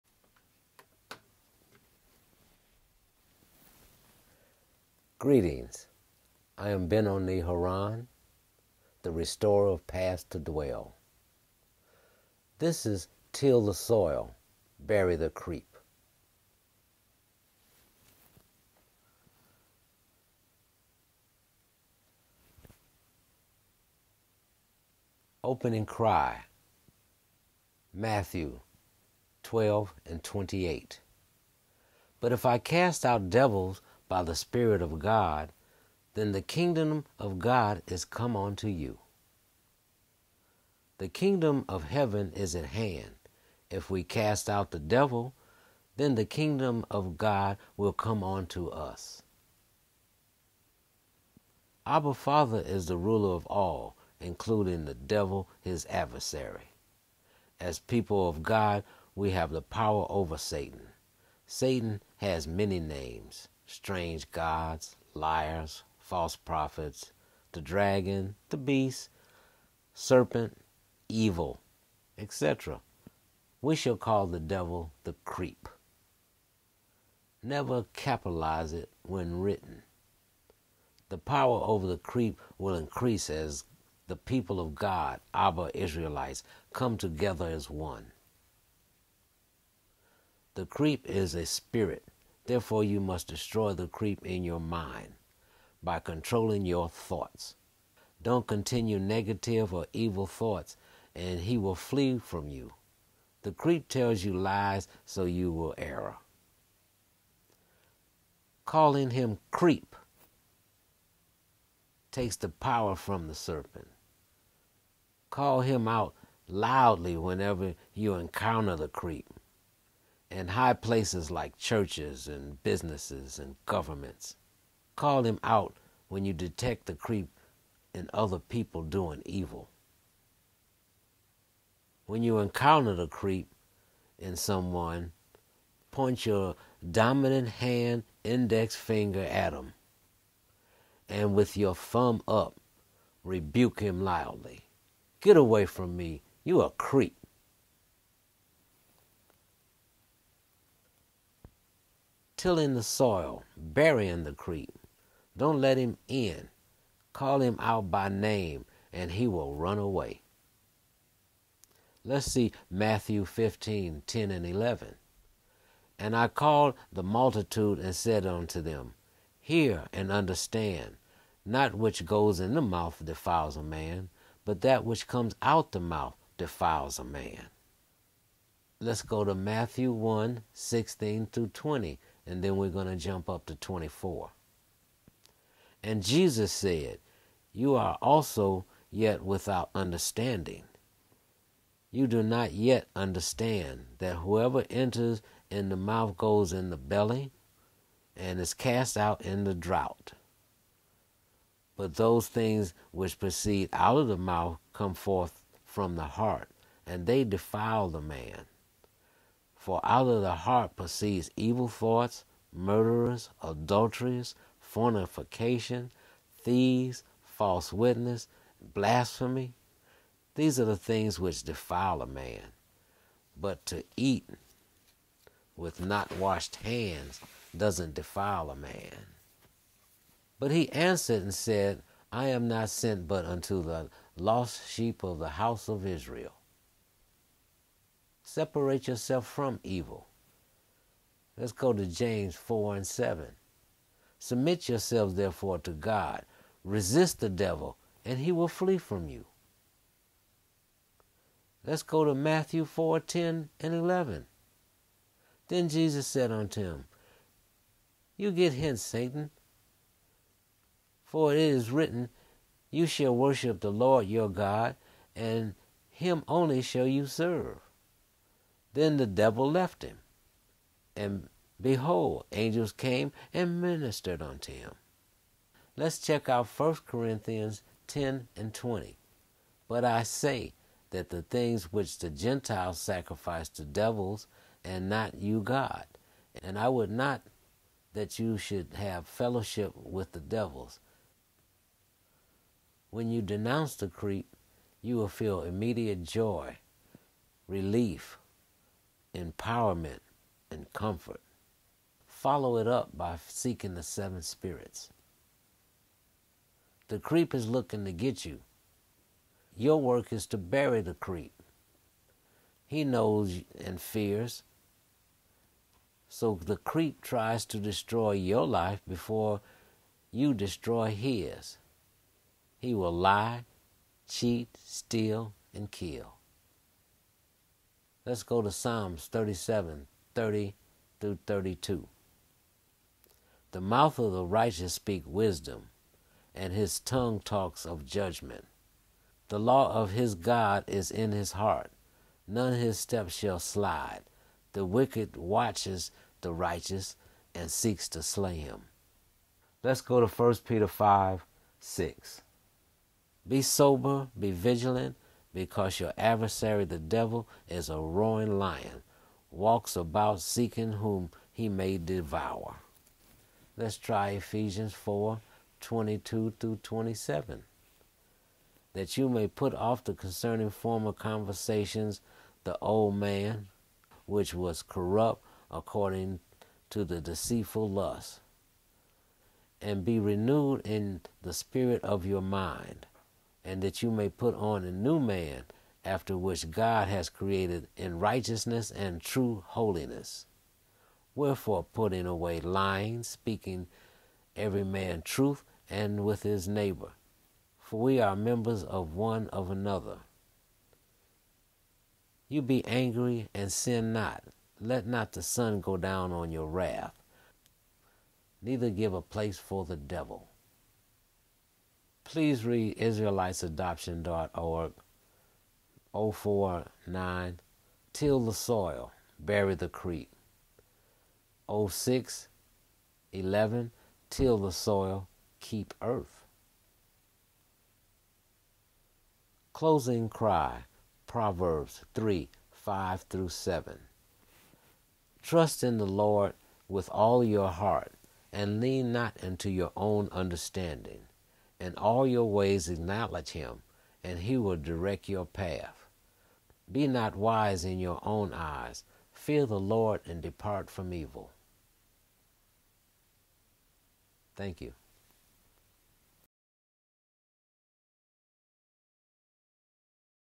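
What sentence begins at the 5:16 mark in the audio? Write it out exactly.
So the creep tries to destroy your life before you destroy his.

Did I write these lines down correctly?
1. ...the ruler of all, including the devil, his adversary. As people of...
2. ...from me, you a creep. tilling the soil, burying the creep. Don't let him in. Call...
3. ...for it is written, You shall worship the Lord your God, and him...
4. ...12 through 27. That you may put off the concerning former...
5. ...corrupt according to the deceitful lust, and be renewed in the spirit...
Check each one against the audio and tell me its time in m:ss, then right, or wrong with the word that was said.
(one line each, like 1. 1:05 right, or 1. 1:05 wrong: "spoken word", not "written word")
1. 0:52 right
2. 2:25 right
3. 4:21 right
4. 6:05 wrong: "22", not "12"
5. 6:14 right.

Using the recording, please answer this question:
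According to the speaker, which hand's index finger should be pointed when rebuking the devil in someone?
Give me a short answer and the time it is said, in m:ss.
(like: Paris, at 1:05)
dominant hand, at 2:16.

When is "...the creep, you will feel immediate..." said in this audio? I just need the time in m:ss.
4:53.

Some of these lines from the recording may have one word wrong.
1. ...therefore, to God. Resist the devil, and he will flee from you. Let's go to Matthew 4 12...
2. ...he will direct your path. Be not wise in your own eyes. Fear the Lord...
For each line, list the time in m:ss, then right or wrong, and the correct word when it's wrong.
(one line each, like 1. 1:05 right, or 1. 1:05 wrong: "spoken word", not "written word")
1. 4:05 wrong: "10", not "12"
2. 7:24 right.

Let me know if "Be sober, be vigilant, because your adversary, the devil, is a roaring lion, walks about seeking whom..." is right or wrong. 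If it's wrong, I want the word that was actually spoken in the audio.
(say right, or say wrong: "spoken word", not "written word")
right.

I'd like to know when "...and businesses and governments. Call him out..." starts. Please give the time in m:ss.
2:02.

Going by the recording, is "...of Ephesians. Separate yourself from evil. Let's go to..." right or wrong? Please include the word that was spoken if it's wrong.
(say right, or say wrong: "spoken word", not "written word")
wrong: "Israel", not "Ephesians".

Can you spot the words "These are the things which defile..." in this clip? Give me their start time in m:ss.
3:40.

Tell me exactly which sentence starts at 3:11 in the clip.
You do not yet understand that whoever enters in the mouth goes in the belly and is cast out in the drought.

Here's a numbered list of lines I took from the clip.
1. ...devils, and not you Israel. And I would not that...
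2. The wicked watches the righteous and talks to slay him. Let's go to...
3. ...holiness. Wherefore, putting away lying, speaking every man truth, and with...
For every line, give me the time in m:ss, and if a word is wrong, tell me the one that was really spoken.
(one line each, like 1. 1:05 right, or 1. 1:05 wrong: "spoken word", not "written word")
1. 4:43 wrong: "God", not "Israel"
2. 5:44 wrong: "seeks", not "talks"
3. 6:29 right.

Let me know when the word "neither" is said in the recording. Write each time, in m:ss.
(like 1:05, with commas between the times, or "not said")
6:48.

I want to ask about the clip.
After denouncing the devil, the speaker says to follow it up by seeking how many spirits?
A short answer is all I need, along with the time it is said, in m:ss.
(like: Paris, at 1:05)
7, at 5:03.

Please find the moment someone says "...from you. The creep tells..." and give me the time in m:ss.
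1:42.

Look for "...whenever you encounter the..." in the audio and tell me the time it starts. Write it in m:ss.
1:57.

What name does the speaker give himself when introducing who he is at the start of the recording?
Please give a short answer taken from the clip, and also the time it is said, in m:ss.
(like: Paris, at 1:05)
Benoni Haran, at 0:06.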